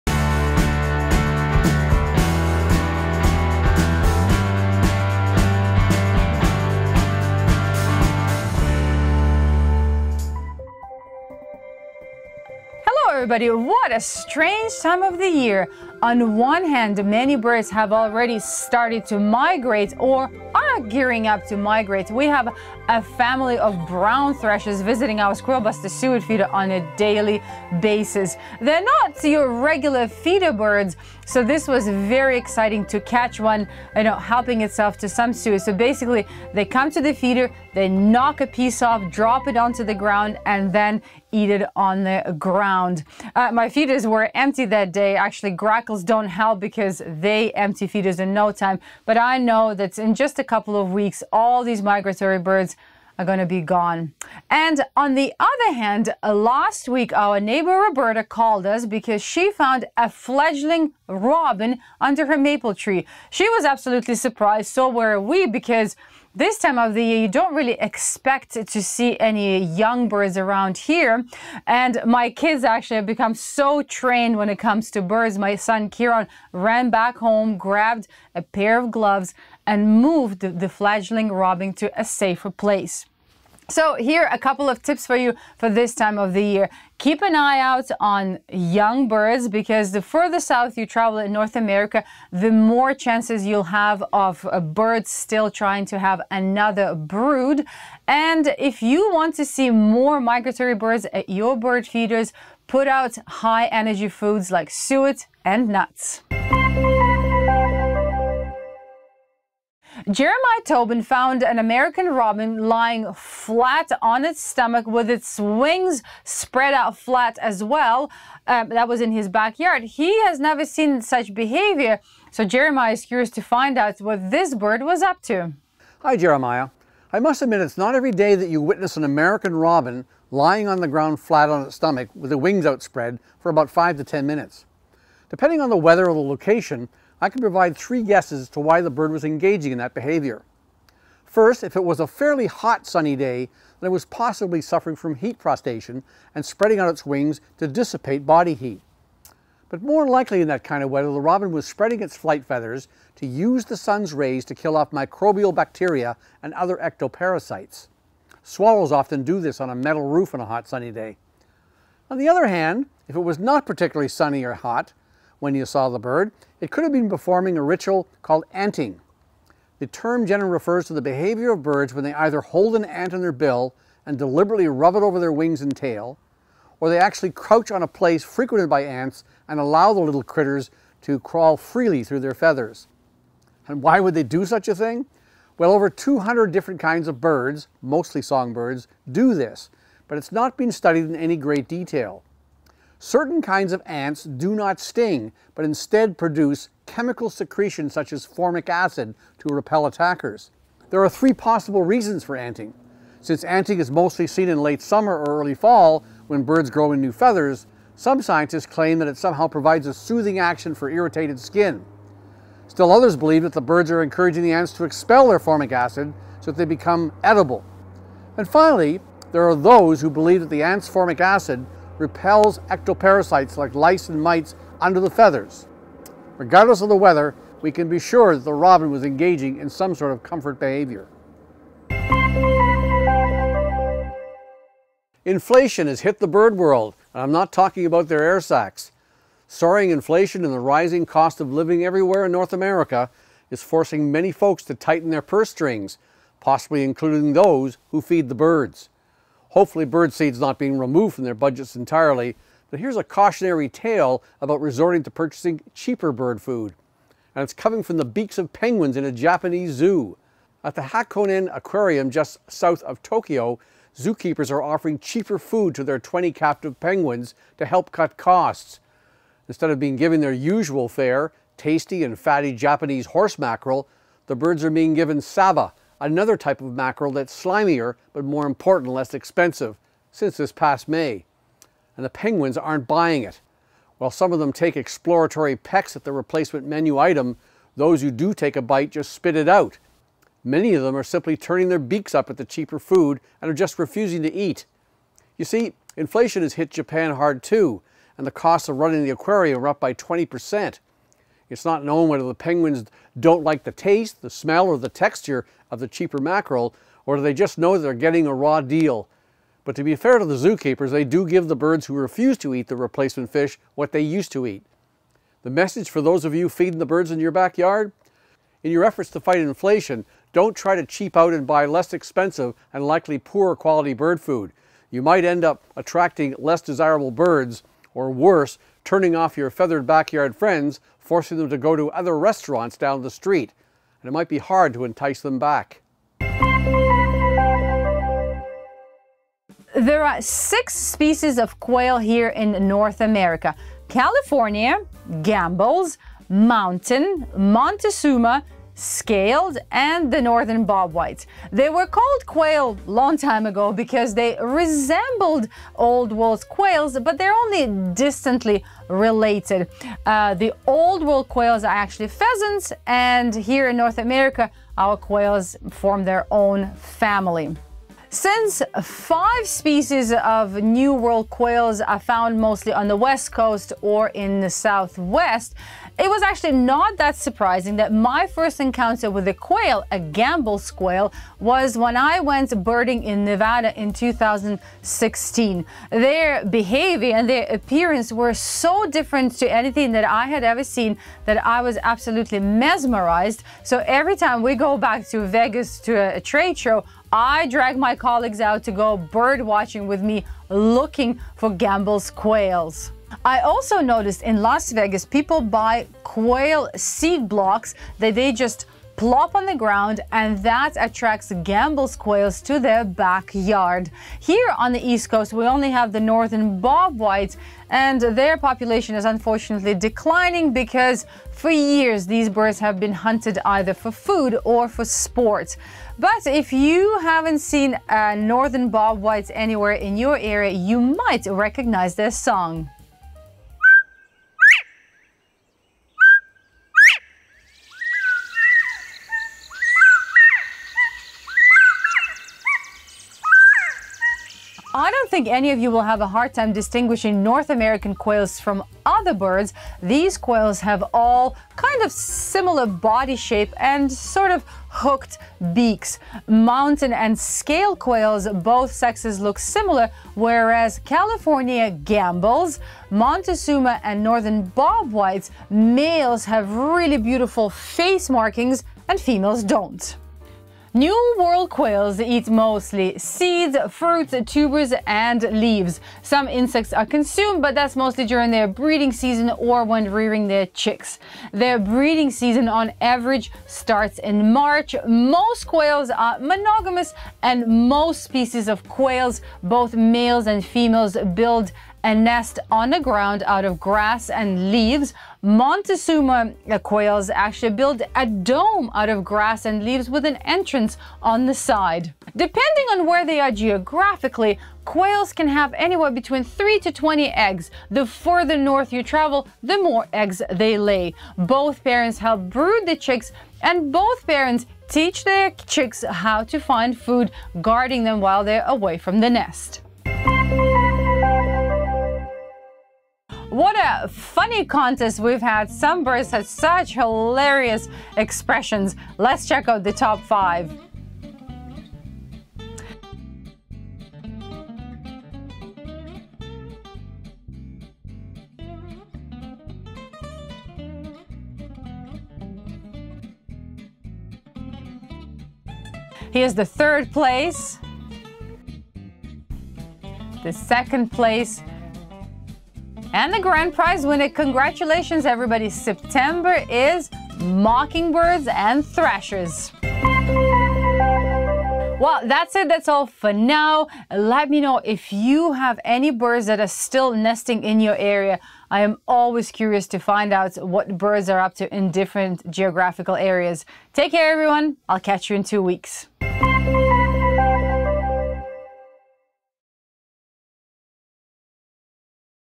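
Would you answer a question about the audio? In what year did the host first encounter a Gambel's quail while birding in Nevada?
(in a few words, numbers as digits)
2016.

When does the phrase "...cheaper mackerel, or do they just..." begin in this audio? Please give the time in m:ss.
5:05.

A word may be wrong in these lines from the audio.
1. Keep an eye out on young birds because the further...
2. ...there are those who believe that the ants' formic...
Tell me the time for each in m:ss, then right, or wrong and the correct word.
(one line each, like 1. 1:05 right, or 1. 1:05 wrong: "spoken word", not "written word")
1. 1:26 right
2. 3:39 right.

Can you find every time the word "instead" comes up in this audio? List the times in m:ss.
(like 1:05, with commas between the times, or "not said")
3:15, 4:29.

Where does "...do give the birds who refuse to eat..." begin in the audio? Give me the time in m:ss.
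5:11.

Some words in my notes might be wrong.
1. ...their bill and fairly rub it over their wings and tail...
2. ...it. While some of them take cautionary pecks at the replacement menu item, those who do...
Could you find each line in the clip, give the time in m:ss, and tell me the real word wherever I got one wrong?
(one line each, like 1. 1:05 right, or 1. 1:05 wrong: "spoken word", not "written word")
1. 2:53 wrong: "deliberately", not "fairly"
2. 4:43 wrong: "exploratory", not "cautionary".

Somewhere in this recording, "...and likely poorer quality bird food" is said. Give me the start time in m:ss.
5:22.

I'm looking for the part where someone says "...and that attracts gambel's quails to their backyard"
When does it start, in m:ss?
6:50.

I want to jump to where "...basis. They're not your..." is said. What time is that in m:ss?
0:27.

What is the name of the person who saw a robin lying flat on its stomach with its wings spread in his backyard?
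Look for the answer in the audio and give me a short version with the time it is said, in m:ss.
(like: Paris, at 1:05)
Jeremiah Tobin, at 1:50.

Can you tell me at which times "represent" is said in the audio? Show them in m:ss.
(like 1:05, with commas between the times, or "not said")
not said.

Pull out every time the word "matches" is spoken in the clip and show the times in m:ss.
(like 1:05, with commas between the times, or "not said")
not said.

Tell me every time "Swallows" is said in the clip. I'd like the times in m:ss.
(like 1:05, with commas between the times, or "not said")
2:38.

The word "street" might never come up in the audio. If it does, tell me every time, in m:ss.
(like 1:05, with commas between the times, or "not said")
5:33.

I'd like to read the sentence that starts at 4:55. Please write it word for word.
You see, inflation has hit Japan hard too, and the costs of running the aquarium are up by 20%.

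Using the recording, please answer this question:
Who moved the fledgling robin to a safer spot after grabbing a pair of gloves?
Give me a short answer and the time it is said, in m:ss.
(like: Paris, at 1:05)
Kieran, at 1:15.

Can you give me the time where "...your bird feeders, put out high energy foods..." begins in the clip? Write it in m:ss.
1:41.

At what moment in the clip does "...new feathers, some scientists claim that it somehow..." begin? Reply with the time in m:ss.
3:27.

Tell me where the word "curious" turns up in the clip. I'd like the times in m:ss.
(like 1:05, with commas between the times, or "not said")
2:03, 9:29.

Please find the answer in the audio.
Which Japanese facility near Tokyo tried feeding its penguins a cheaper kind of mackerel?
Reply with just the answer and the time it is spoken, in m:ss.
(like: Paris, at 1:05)
Hakone Aquarium, at 4:20.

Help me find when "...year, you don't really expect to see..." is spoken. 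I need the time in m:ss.
1:07.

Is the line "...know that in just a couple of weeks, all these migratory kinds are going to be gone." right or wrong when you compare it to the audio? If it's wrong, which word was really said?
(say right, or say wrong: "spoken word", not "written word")
wrong: "birds", not "kinds".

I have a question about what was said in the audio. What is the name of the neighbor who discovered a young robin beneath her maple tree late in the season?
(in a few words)
Roberta.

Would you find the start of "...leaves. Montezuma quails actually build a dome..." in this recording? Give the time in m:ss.
8:14.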